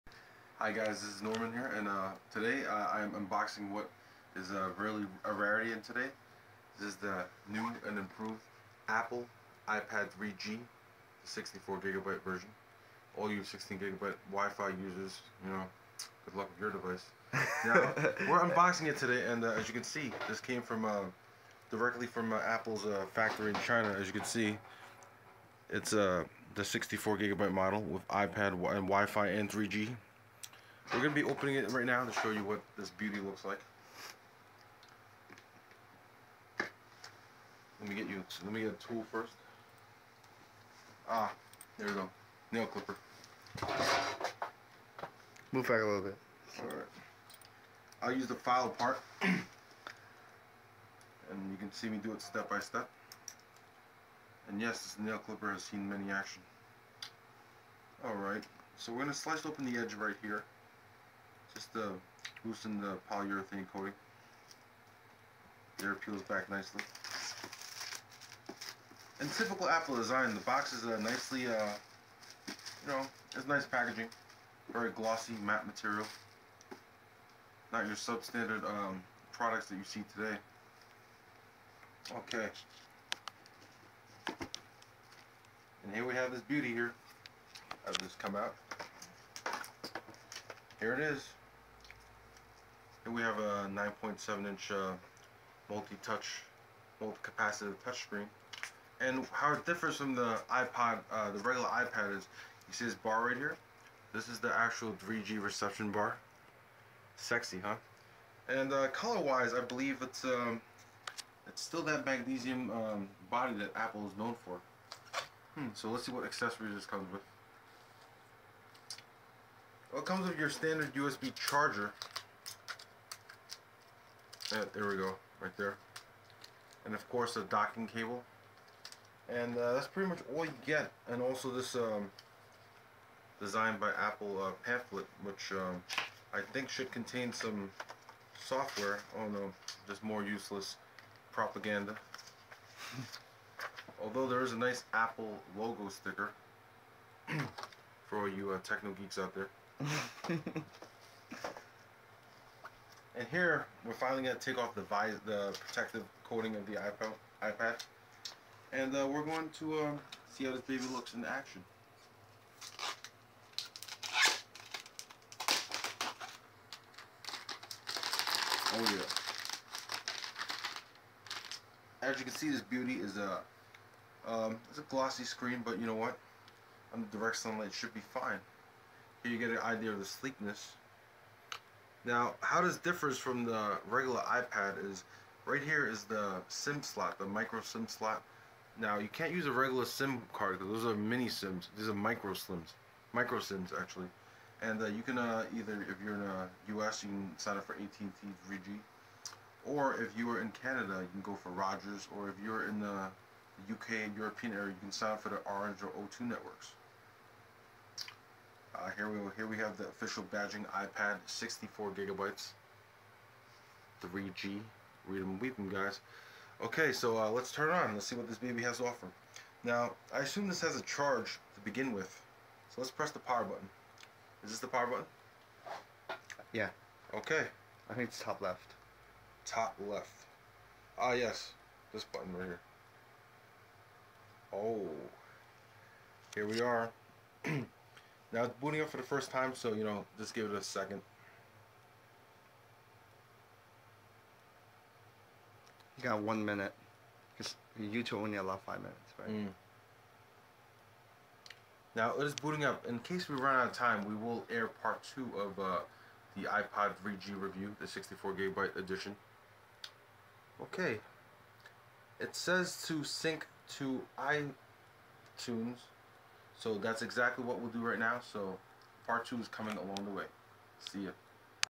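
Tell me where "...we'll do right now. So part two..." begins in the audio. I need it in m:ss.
4:27.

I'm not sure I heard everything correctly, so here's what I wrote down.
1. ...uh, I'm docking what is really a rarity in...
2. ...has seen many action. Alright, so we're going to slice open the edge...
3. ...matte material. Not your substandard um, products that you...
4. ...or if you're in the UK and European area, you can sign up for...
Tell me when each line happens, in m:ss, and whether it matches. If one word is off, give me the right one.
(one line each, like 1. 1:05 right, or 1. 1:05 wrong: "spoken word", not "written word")
1. 0:02 wrong: "unboxing", not "docking"
2. 0:55 right
3. 1:15 right
4. 3:22 right.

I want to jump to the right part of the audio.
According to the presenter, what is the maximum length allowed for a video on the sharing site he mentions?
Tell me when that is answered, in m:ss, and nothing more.
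4:08.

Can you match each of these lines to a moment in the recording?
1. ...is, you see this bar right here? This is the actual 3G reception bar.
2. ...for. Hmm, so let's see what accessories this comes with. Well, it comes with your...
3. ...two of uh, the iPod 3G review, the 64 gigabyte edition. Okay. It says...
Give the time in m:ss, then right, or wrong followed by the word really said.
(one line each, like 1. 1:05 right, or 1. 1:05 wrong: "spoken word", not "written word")
1. 1:42 right
2. 1:54 right
3. 4:15 right.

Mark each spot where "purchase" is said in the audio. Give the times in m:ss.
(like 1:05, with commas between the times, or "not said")
not said.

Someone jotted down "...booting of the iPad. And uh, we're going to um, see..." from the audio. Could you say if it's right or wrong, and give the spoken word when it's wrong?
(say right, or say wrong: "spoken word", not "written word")
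wrong: "coating", not "booting".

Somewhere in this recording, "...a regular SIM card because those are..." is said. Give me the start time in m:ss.
3:09.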